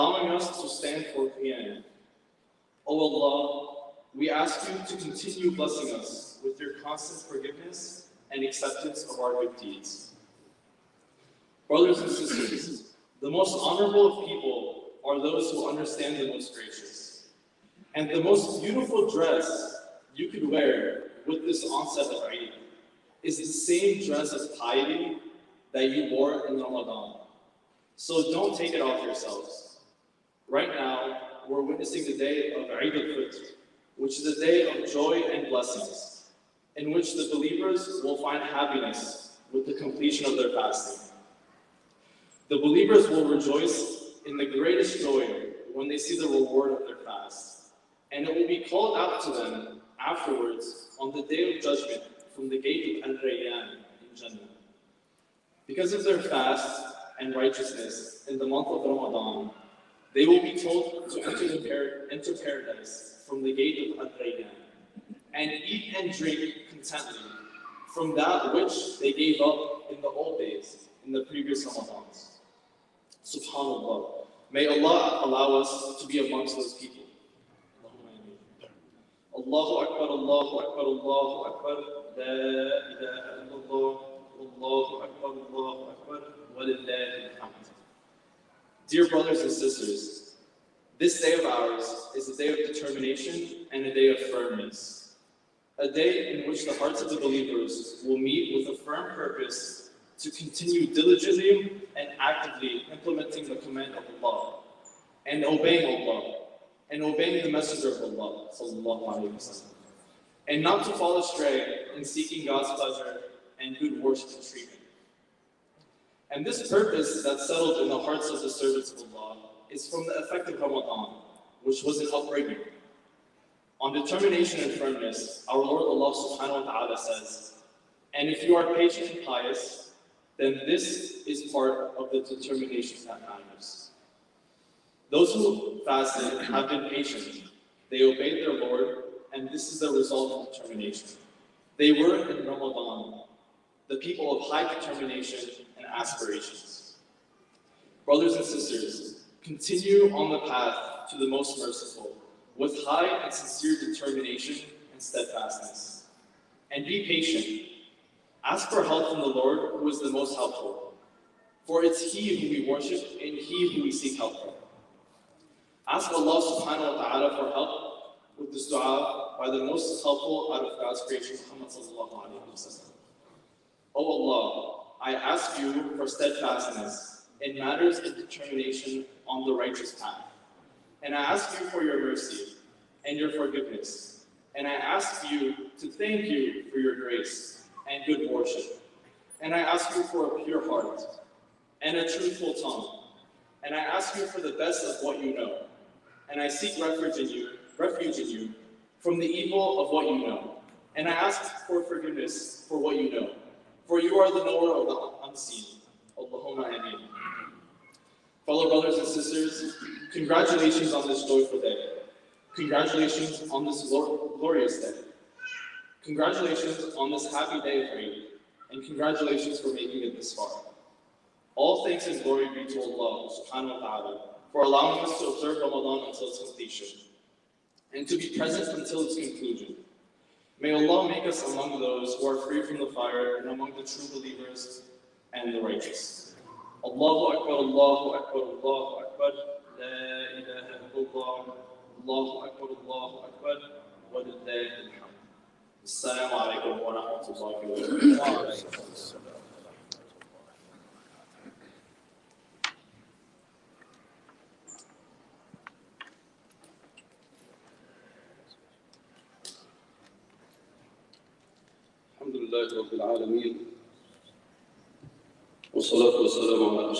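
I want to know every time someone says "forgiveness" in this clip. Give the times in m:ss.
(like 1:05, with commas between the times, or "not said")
0:07, 3:03, 3:21.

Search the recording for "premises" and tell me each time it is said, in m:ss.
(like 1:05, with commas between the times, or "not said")
not said.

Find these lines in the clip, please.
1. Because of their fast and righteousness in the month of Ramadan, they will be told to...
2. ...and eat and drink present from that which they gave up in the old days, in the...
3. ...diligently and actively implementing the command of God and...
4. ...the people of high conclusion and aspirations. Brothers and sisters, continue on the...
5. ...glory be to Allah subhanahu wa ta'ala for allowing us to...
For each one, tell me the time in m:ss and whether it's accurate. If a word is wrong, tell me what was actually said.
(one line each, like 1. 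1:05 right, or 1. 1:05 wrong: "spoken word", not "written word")
1. 0:55 right
2. 1:05 wrong: "contentment", not "present"
3. 1:40 wrong: "Allah", not "God"
4. 2:23 wrong: "determination", not "conclusion"
5. 3:42 right.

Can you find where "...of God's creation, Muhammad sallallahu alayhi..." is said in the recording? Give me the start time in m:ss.
2:50.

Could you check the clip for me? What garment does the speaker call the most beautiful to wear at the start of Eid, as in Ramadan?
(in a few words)
dress of piety.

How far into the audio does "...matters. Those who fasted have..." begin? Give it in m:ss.
2:13.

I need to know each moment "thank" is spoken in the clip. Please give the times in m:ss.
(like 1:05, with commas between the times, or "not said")
3:05, 3:41.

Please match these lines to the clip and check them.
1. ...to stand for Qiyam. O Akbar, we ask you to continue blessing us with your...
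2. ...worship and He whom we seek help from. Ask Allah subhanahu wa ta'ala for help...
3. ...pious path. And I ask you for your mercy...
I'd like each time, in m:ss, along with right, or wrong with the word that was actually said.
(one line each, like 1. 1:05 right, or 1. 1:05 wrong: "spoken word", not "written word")
1. 0:00 wrong: "Allah", not "Akbar"
2. 2:42 right
3. 2:59 wrong: "righteous", not "pious".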